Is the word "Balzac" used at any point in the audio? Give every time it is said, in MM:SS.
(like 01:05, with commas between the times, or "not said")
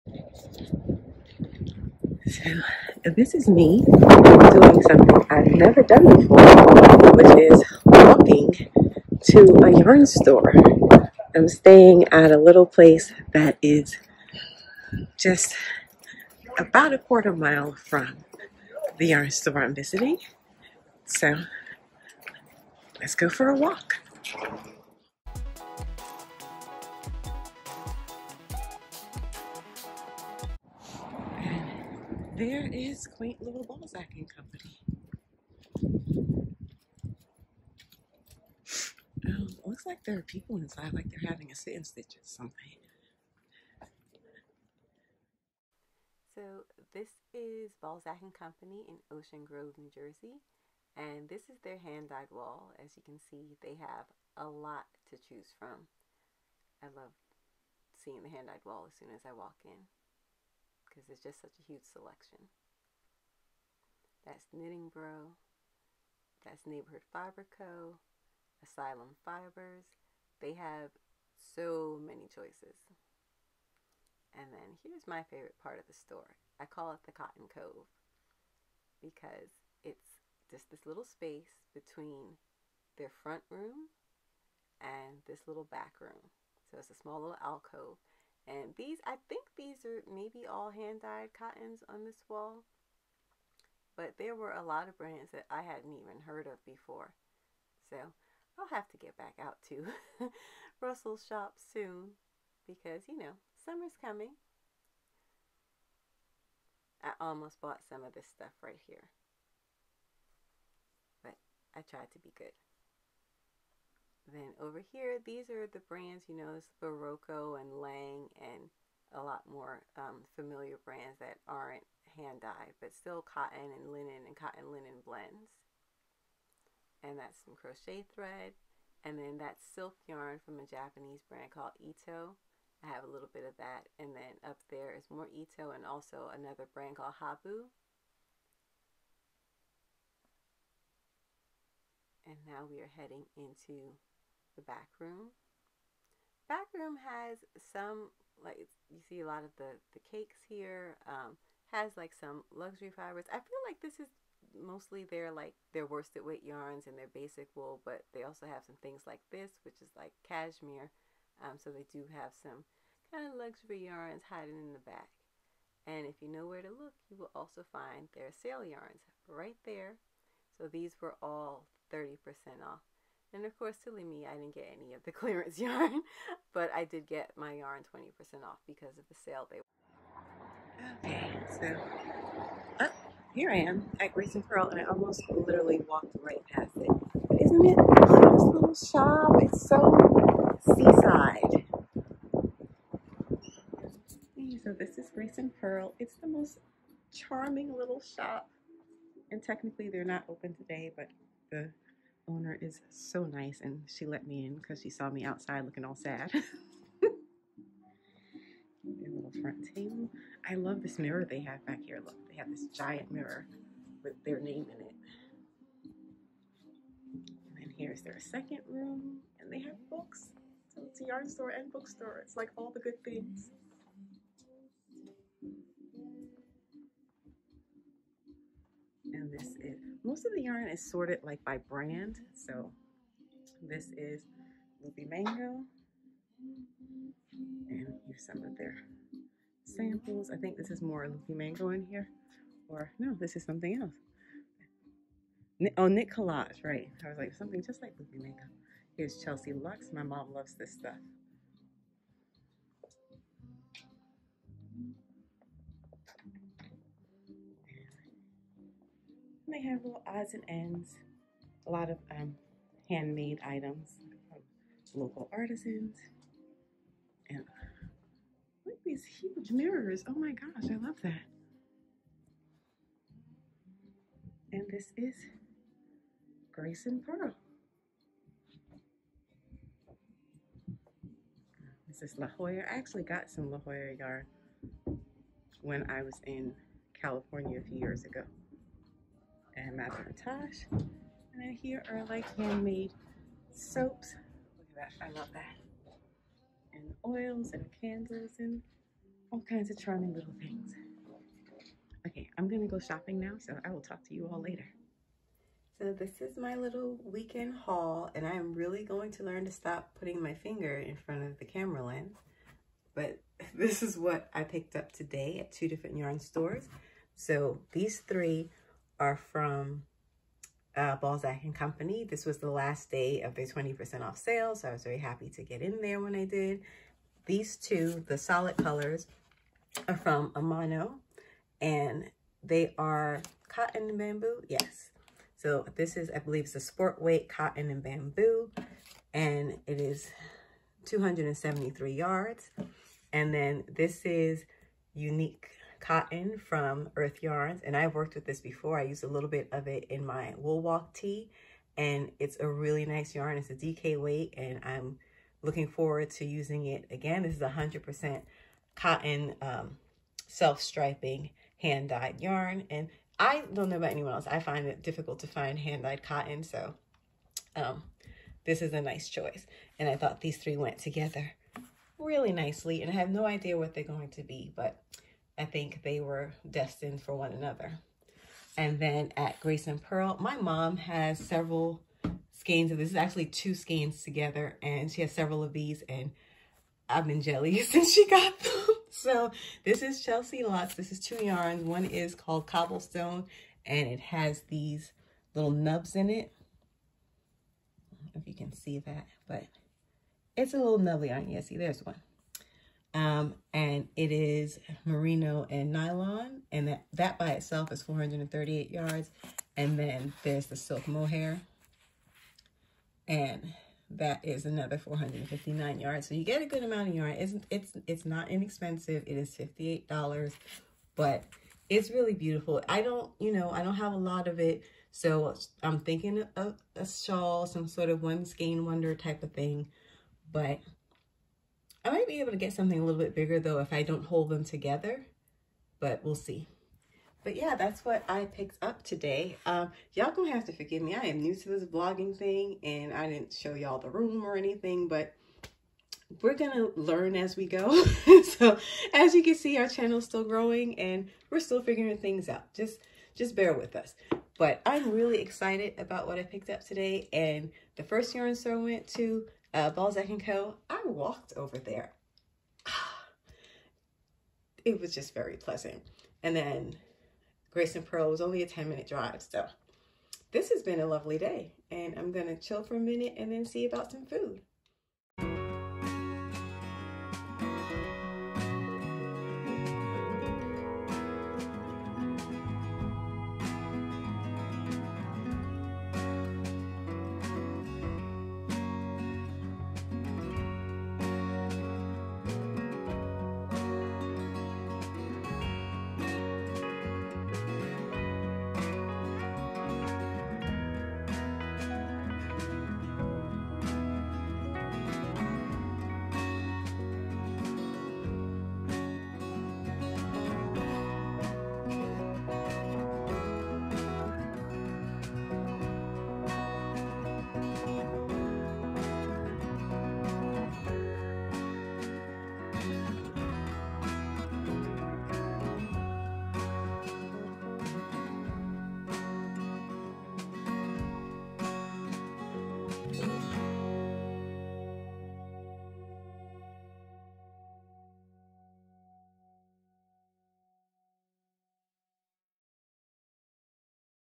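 00:33, 00:47, 05:20, 07:39.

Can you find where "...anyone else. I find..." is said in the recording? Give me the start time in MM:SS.
06:03.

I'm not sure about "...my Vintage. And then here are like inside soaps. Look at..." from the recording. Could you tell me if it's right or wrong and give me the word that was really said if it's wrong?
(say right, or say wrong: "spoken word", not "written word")
wrong: "handmade", not "inside".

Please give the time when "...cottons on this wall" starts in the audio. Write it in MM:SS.
01:31.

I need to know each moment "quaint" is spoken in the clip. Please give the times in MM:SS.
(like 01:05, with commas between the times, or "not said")
00:33.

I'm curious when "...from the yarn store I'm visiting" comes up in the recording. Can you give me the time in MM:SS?
00:17.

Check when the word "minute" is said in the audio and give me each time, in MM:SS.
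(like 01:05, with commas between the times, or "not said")
07:48, 07:52.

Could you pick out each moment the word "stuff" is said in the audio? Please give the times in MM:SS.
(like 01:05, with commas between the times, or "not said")
01:48, 04:10.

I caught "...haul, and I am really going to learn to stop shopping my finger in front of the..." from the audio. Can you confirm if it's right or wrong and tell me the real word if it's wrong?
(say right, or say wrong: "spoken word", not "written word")
wrong: "putting", not "shopping".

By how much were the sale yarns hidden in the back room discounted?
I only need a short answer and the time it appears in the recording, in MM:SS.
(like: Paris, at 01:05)
30%, at 02:51.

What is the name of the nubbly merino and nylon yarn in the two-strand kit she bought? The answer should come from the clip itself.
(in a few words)
Cobblestone.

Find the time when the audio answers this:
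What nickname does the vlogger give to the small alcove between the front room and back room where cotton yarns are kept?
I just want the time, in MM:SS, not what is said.
01:17.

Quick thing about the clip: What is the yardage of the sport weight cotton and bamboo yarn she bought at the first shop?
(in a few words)
273 yards.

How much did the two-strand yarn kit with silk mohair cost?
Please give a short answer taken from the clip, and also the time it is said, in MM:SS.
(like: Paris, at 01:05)
$58, at 06:59.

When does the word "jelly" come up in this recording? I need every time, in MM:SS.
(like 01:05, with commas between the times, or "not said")
06:27.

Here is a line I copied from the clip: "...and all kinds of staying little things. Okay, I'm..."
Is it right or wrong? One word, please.
wrong.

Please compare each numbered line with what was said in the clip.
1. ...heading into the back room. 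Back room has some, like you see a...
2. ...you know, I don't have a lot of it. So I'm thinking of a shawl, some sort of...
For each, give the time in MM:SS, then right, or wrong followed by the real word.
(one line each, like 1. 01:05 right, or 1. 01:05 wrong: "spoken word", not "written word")
1. 02:22 right
2. 07:03 right.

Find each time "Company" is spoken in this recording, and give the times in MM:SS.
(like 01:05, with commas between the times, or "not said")
00:34, 00:48, 05:21.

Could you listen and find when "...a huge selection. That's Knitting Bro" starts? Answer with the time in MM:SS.
01:01.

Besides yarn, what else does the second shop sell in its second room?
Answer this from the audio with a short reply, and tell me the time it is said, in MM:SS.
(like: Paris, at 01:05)
Books, at 03:41.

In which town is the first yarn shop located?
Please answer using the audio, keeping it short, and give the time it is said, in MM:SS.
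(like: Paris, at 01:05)
Ocean Grove, New Jersey, at 00:49.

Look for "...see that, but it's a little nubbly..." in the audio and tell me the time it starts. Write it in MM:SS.
06:38.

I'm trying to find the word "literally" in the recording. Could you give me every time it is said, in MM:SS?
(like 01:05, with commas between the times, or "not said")
03:05.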